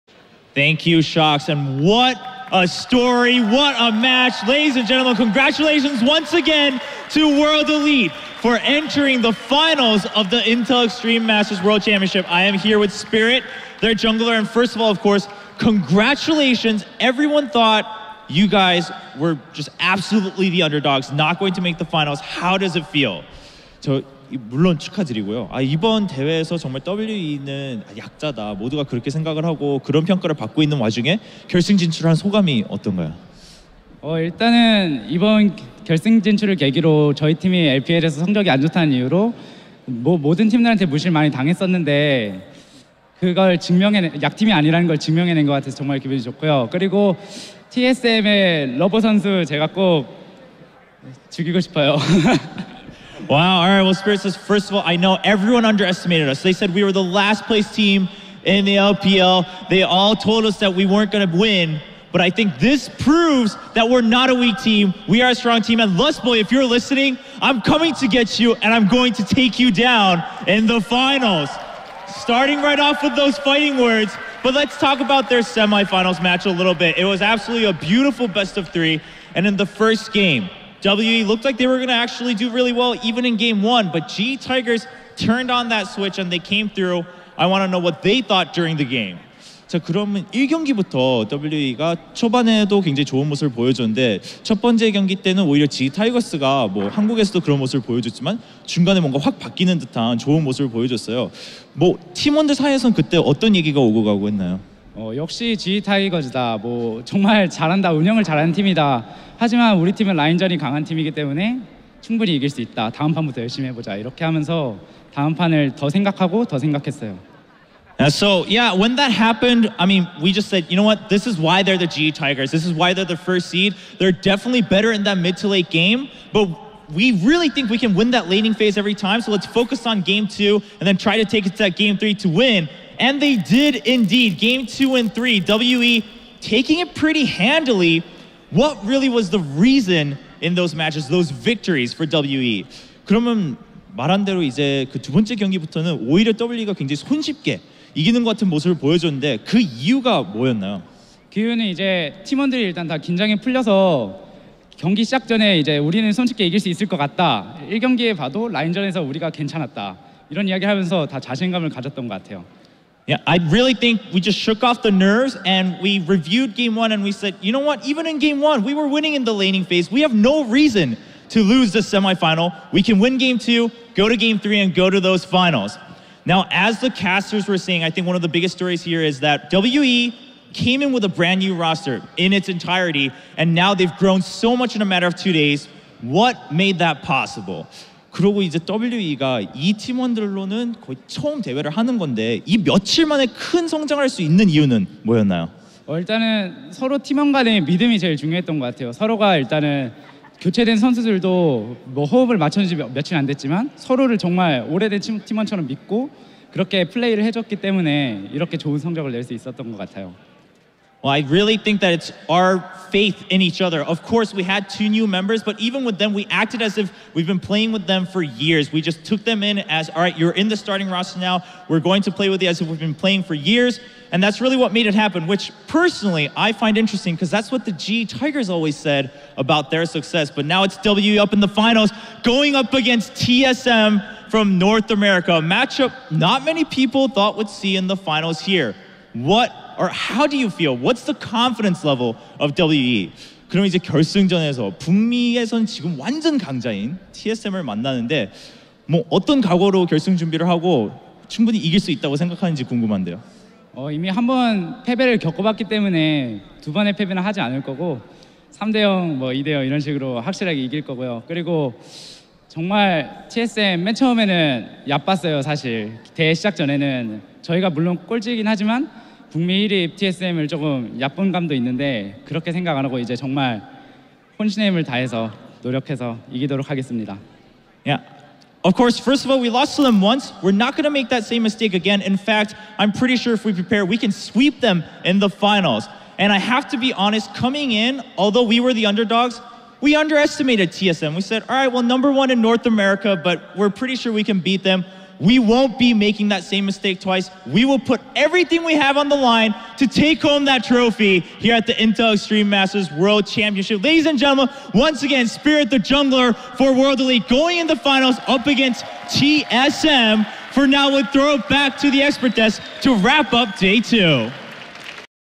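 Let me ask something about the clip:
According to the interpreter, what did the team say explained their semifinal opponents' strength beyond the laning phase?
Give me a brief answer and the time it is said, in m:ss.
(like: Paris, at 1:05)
First seed, at 2:03.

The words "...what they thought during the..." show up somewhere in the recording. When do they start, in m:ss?
1:27.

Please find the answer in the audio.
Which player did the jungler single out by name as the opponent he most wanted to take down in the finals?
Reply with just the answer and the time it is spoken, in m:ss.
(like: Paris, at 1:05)
Lustboy, at 1:05.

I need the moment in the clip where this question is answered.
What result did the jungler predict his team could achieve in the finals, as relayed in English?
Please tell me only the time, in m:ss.
4:44.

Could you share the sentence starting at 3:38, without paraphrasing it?
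We just took them in as, all right, you're in the starting roster now.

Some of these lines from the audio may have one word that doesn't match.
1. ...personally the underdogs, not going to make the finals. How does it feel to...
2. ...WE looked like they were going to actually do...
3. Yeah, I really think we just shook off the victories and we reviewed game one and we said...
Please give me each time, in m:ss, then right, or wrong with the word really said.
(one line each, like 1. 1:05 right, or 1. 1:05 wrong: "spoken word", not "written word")
1. 0:19 wrong: "absolutely", not "personally"
2. 1:20 right
3. 2:43 wrong: "nerves", not "victories".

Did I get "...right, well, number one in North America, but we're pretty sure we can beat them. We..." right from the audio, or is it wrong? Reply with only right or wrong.
right.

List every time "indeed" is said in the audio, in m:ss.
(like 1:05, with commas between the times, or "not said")
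2:13.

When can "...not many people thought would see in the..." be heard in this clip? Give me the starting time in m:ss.
3:56.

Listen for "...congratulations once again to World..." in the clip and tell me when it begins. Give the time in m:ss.
0:05.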